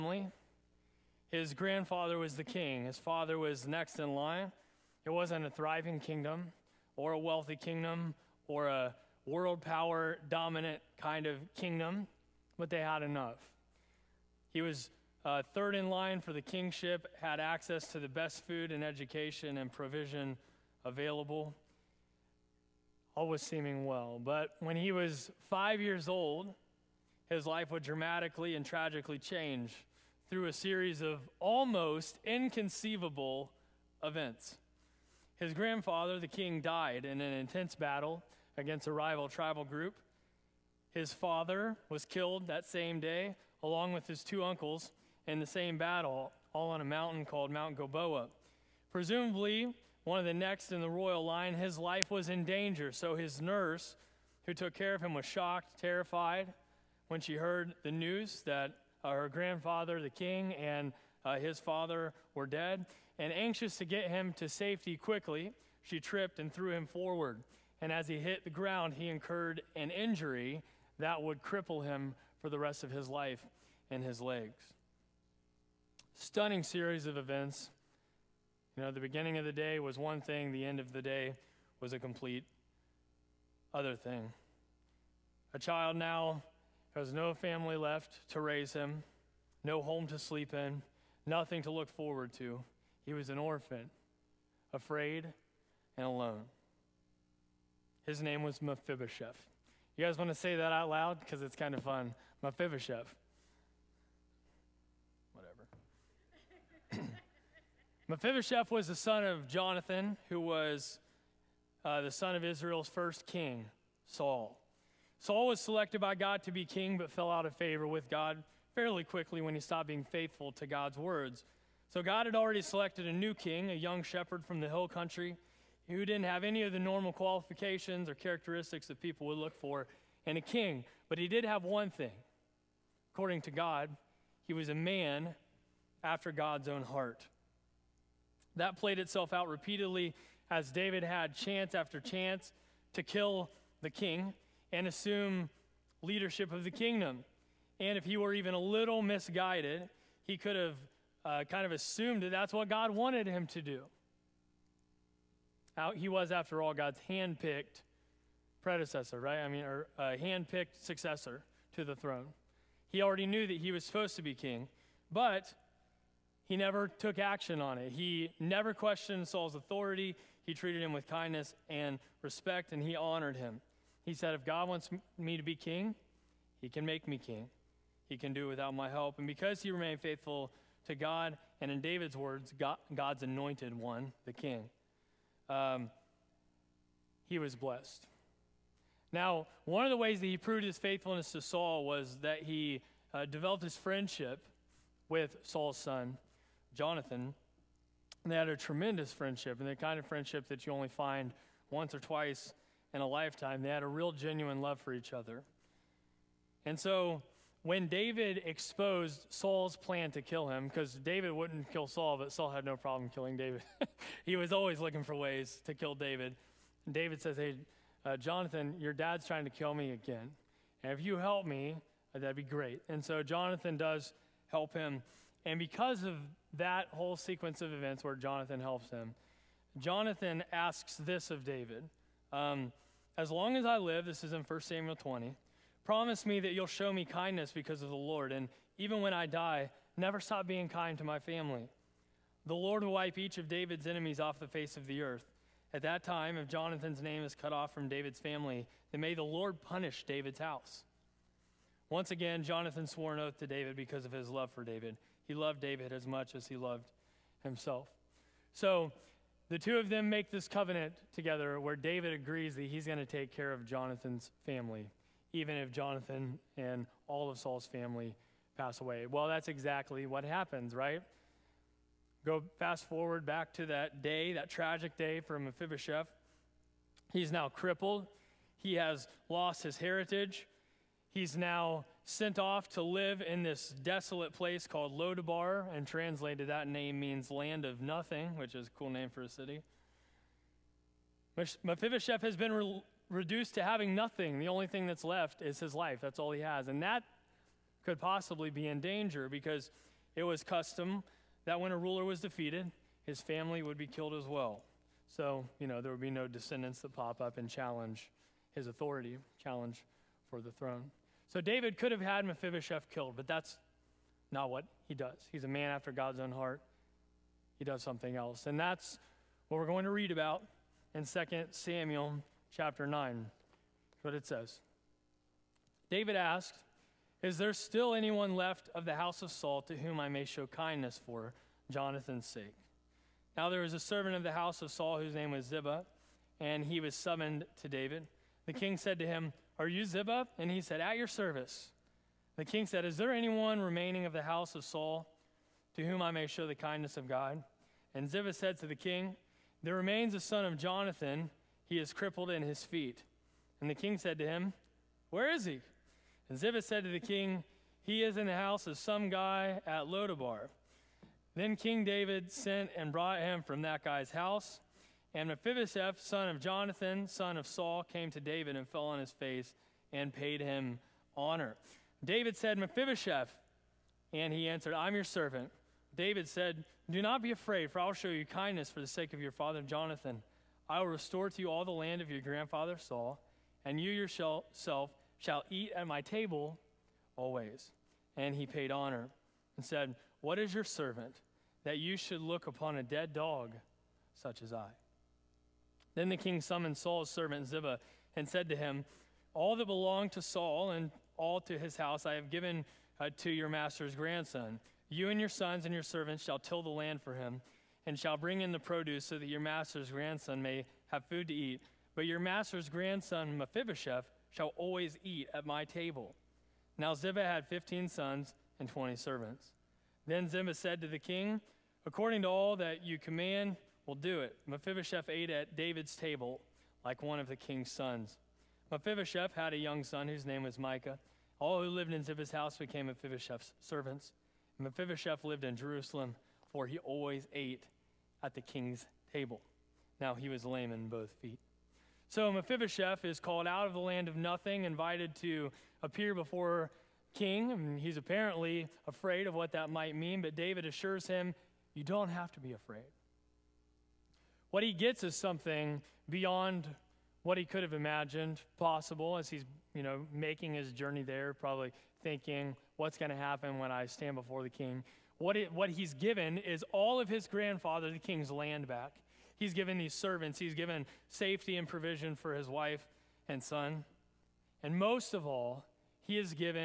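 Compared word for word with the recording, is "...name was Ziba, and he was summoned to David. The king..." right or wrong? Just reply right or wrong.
right.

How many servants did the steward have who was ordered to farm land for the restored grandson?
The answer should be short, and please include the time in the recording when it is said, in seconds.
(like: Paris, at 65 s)
20, at 418 s.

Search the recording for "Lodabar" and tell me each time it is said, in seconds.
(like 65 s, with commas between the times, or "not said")
284 s, 359 s.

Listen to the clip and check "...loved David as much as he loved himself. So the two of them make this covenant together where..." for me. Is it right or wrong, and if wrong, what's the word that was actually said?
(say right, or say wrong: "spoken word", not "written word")
right.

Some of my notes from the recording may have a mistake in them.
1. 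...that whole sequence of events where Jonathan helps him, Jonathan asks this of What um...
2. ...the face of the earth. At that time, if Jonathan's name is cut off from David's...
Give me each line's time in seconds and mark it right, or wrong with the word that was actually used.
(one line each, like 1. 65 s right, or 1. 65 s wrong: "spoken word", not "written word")
1. 226 s wrong: "David", not "What"
2. 244 s right.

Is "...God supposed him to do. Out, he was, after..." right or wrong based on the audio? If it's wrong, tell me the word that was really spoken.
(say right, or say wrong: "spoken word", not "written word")
wrong: "wanted", not "supposed".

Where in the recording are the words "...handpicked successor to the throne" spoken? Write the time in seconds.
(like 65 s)
160 s.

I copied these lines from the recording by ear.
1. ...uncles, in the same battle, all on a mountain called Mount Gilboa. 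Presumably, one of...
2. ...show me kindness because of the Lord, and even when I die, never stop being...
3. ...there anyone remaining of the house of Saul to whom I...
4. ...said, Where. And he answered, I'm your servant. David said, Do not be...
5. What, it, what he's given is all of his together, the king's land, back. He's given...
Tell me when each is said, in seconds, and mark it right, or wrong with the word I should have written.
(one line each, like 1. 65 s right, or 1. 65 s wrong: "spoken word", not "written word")
1. 44 s right
2. 236 s right
3. 342 s right
4. 372 s wrong: "Mephibosheth", not "Where"
5. 465 s wrong: "grandfather", not "together".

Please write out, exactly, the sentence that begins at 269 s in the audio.
Well, that's exactly what happens, right?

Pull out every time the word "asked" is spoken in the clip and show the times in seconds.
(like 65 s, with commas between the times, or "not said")
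326 s.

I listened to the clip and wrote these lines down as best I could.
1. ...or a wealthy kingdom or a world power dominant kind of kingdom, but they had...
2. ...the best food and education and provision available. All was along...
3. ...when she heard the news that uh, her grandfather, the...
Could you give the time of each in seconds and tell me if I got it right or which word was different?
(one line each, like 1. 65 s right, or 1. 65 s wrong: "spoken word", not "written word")
1. 6 s right
2. 17 s wrong: "seeming", not "along"
3. 57 s right.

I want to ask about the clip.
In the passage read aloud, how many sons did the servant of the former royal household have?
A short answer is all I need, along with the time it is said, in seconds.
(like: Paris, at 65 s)
15, at 417 s.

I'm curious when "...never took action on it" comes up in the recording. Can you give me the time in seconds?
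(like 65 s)
166 s.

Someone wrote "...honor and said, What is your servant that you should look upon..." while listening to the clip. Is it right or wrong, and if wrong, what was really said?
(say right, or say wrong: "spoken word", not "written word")
right.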